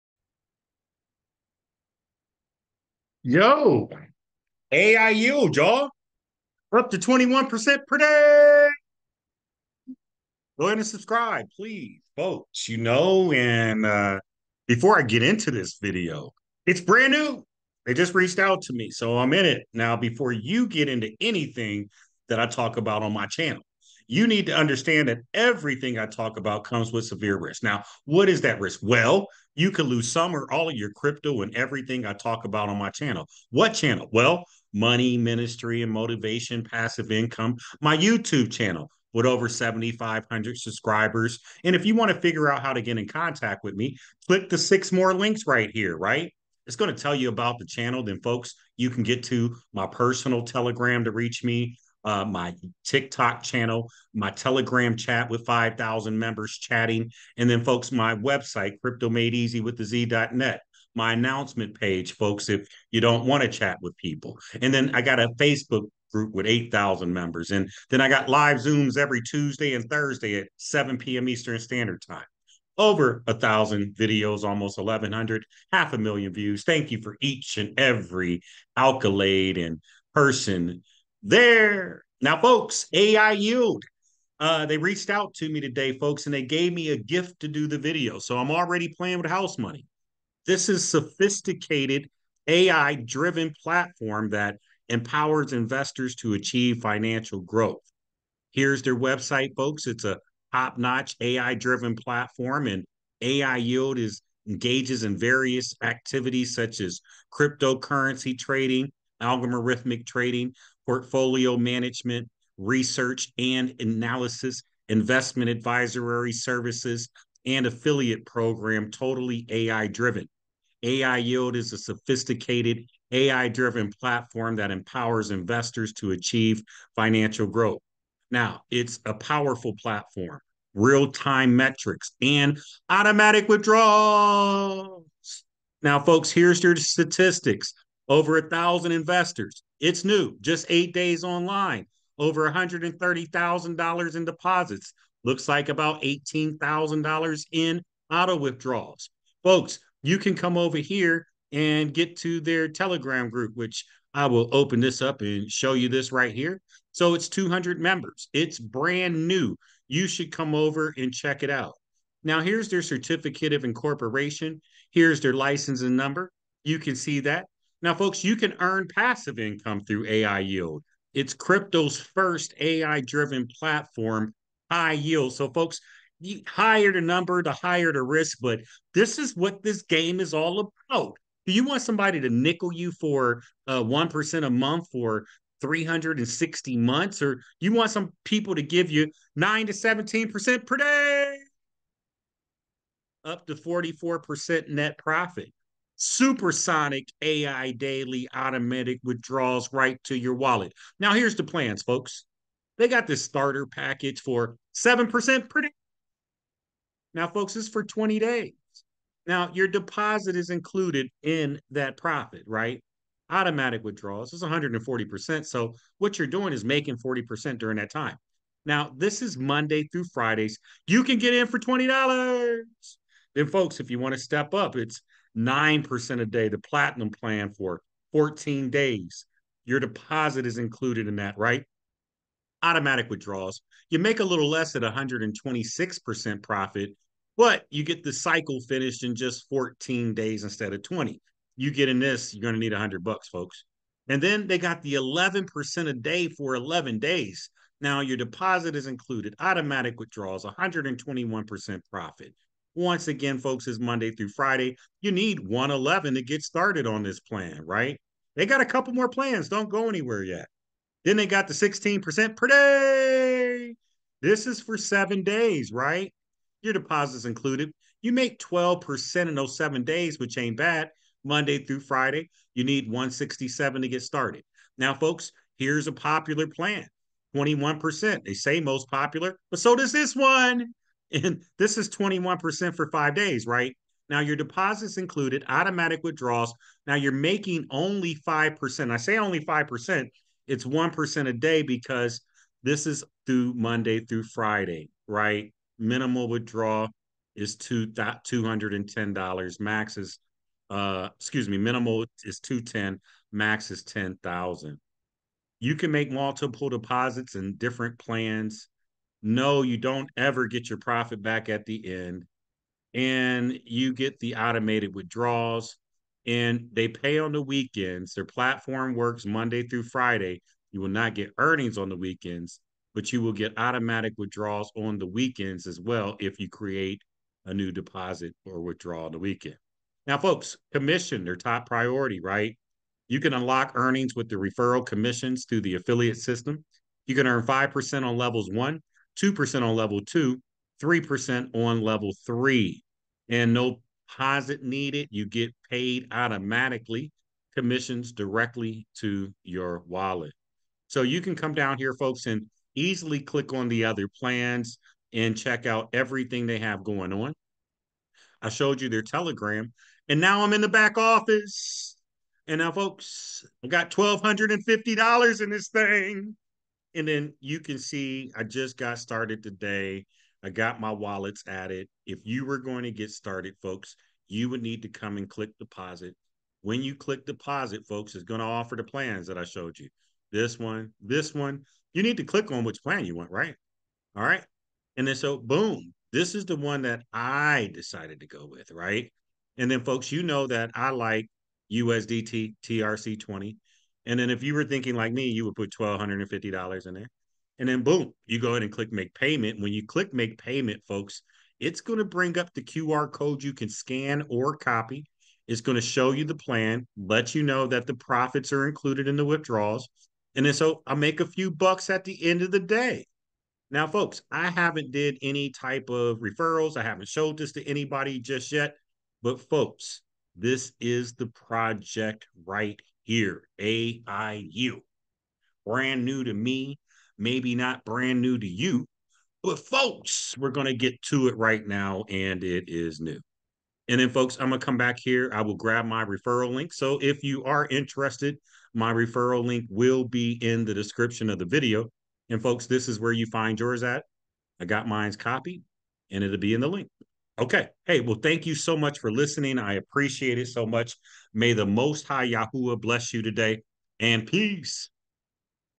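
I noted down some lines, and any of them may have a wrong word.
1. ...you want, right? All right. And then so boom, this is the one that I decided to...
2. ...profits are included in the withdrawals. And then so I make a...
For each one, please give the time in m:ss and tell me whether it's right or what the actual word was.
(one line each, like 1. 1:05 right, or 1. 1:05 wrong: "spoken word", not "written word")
1. 6:23 right
2. 6:47 right.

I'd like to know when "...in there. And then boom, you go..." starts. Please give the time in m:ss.
6:36.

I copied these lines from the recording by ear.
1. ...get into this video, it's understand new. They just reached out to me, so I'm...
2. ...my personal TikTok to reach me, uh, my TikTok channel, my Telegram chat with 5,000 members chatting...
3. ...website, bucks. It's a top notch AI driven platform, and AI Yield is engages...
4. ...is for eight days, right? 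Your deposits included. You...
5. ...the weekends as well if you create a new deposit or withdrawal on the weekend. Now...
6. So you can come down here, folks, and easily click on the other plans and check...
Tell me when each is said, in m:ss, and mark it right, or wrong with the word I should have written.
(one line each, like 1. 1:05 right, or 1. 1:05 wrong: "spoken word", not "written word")
1. 0:15 wrong: "brand", not "understand"
2. 0:49 wrong: "Telegram", not "TikTok"
3. 1:38 wrong: "folks", not "bucks"
4. 4:24 wrong: "seven", not "eight"
5. 5:24 right
6. 5:50 right.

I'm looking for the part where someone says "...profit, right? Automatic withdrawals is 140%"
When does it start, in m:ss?
3:31.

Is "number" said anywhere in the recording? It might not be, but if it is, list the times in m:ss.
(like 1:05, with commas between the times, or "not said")
2:45, 2:57.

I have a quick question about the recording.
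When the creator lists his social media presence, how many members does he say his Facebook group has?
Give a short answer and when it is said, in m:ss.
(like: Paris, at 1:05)
8,000, at 1:06.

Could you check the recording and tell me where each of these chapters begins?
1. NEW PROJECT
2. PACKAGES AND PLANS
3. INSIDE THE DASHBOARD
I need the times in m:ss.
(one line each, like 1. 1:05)
1. 1:27
2. 5:48
3. 7:22.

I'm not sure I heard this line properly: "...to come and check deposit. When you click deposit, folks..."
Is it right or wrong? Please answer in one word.
wrong.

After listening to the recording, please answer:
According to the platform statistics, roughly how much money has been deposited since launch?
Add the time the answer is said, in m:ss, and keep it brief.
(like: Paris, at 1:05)
$130,000, at 2:22.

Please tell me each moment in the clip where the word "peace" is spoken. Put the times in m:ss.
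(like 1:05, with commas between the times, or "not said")
7:34.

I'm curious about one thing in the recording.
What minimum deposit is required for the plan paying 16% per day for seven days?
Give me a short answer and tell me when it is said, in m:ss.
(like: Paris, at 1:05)
167, at 4:32.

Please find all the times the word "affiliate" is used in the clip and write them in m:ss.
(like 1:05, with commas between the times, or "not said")
1:57, 5:35.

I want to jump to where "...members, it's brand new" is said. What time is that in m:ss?
2:37.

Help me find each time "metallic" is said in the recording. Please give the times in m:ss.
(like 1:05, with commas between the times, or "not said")
not said.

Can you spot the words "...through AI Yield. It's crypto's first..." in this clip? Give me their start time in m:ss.
2:49.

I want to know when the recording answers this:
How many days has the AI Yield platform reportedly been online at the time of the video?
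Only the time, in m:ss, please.
2:20.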